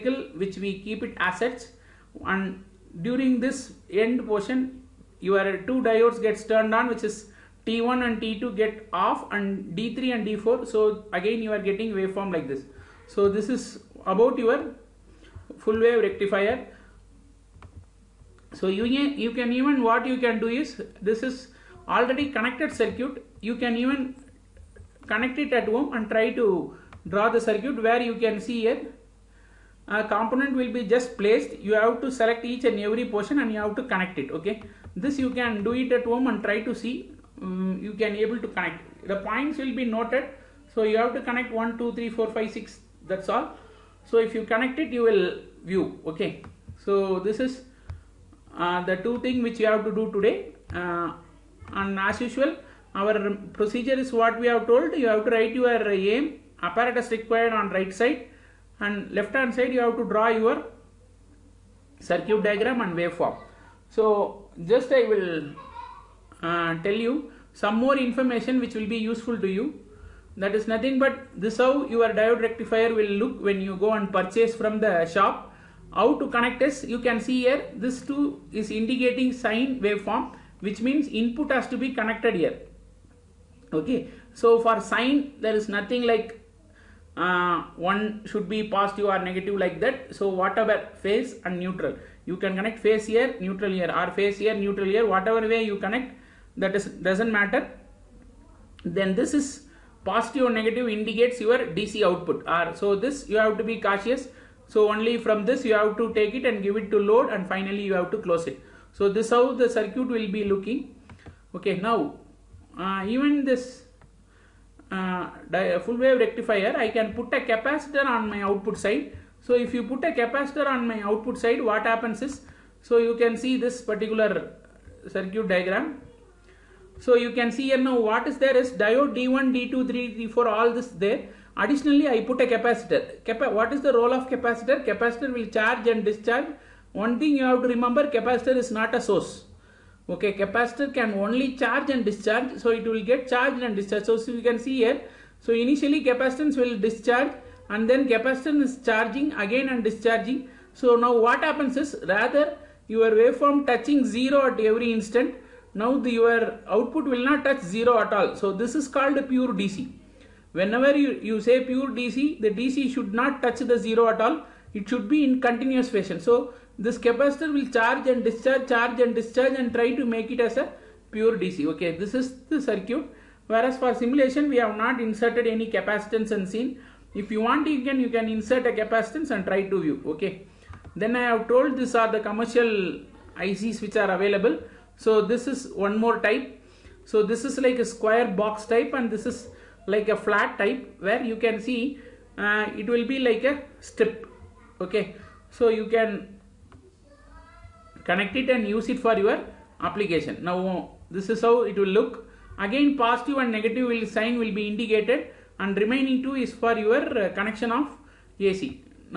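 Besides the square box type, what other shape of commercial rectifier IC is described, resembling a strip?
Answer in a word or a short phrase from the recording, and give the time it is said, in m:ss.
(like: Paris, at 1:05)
flat type, at 3:10.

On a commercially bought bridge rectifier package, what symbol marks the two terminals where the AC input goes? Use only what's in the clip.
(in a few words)
sine waveform.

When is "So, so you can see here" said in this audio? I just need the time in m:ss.
2:24.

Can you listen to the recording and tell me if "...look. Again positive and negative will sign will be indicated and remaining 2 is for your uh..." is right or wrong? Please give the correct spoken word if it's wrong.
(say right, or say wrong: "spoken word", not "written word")
right.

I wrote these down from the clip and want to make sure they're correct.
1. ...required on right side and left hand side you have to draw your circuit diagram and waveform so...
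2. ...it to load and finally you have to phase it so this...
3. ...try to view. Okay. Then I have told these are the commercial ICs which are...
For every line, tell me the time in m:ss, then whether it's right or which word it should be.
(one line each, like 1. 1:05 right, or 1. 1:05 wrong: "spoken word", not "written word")
1. 0:57 right
2. 1:46 wrong: "close", not "phase"
3. 2:59 right.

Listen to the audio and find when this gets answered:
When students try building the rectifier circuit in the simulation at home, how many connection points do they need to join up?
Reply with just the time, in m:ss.
0:41.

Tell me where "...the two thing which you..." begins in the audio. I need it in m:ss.
0:48.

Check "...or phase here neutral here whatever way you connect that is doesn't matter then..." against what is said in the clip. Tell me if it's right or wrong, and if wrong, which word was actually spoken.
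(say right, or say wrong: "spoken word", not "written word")
right.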